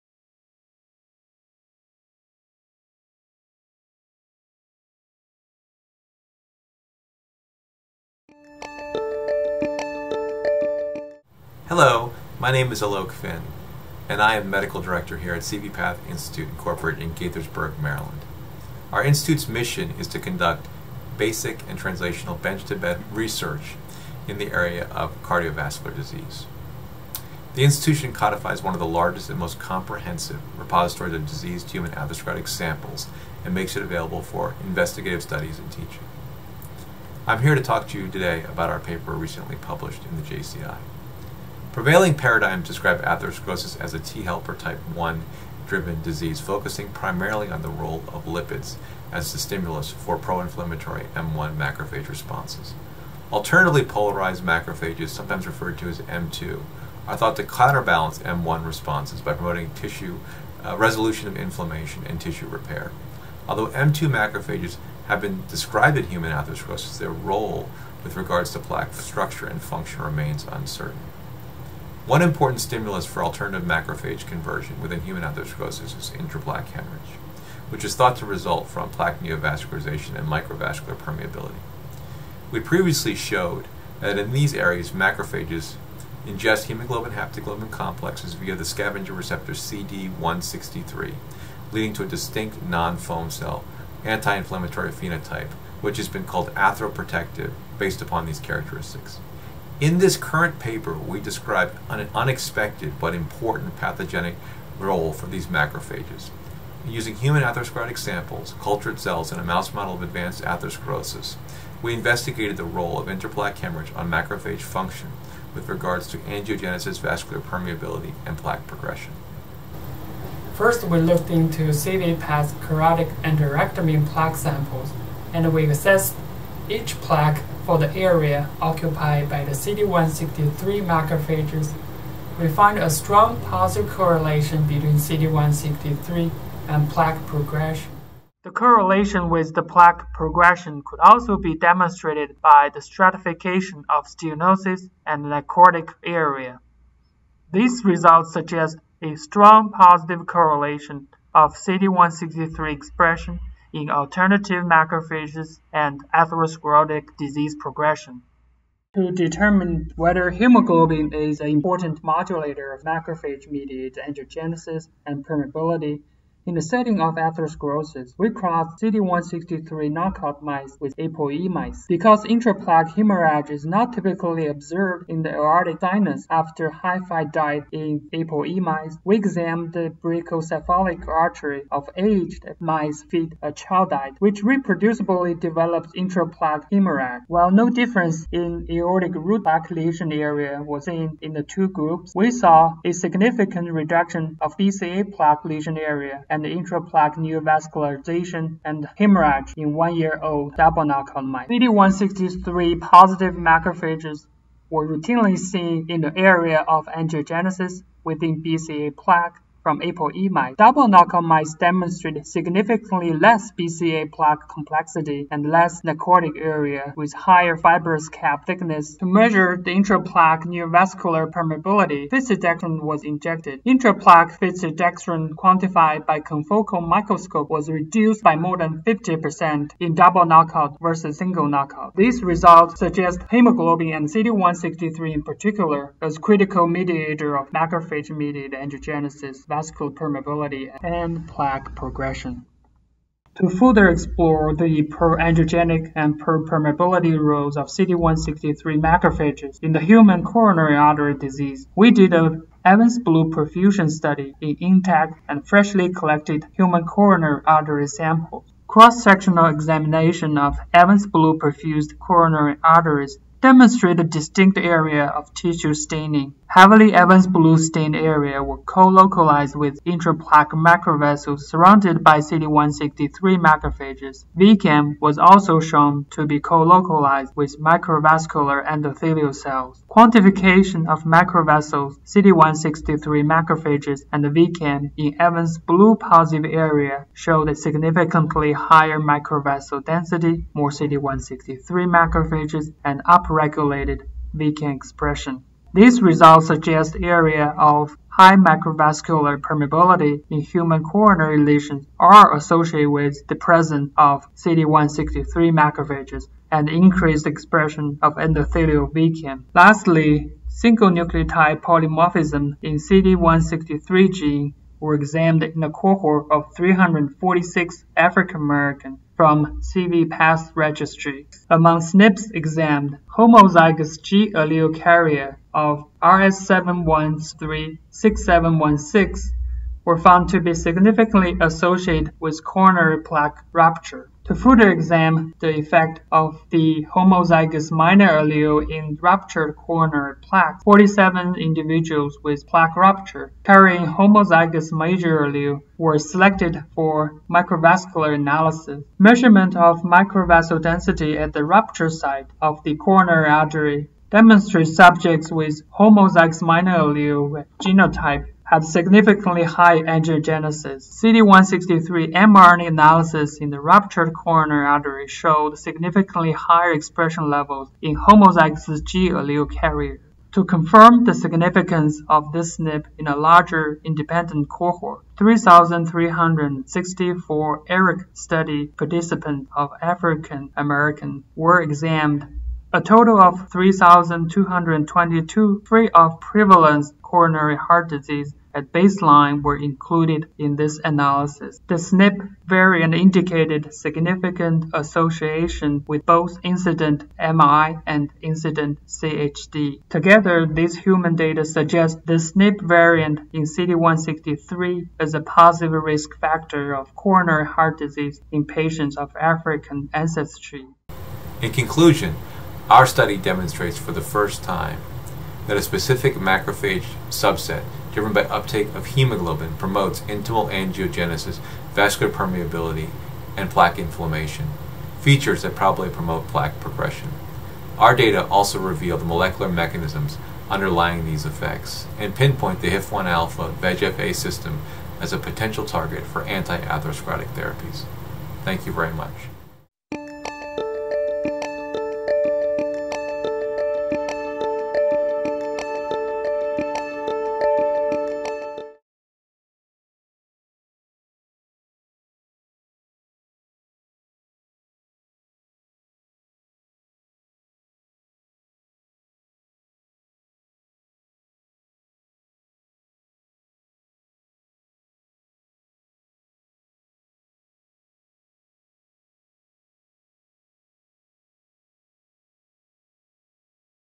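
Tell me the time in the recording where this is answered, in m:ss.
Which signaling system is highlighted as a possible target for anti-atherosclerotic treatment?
7:12.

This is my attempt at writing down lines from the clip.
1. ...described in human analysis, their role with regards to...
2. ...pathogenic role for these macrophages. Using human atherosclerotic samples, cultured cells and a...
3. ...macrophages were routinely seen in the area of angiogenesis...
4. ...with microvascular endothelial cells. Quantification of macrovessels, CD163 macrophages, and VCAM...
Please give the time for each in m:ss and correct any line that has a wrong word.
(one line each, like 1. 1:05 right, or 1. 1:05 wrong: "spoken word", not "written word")
1. 1:05 wrong: "atherosclerosis", not "analysis"
2. 1:43 right
3. 3:23 right
4. 4:37 right.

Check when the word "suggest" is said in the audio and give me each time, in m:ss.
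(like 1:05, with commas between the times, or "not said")
2:28, 3:52, 4:56, 6:41.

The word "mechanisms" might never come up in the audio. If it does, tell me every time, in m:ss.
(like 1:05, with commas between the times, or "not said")
7:09.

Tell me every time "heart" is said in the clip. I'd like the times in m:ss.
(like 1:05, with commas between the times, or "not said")
6:27, 6:47.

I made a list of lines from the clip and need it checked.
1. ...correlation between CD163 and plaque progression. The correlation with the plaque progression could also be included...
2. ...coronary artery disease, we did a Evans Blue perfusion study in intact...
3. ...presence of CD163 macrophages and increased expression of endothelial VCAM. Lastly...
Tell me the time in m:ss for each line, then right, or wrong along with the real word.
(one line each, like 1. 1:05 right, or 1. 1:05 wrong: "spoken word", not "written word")
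1. 2:13 wrong: "demonstrated", not "included"
2. 4:10 right
3. 5:03 right.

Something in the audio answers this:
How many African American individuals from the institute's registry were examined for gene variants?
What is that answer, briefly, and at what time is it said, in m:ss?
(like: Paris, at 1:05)
346, at 5:16.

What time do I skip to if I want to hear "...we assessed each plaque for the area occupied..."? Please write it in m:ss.
2:05.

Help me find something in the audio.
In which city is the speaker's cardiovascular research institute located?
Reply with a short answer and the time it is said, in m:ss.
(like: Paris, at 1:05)
Gaithersburg, Maryland, at 0:17.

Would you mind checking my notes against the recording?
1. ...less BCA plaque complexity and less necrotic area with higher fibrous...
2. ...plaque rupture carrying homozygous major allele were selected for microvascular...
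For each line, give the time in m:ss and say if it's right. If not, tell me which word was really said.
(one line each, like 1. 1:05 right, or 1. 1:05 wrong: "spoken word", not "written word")
1. 3:33 right
2. 5:42 right.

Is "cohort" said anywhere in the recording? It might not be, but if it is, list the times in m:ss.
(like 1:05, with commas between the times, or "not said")
5:15, 6:14.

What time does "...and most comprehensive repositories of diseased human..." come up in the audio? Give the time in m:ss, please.
0:29.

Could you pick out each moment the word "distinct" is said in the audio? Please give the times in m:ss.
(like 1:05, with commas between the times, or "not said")
1:32, 4:24.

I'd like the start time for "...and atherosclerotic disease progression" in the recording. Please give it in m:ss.
2:35.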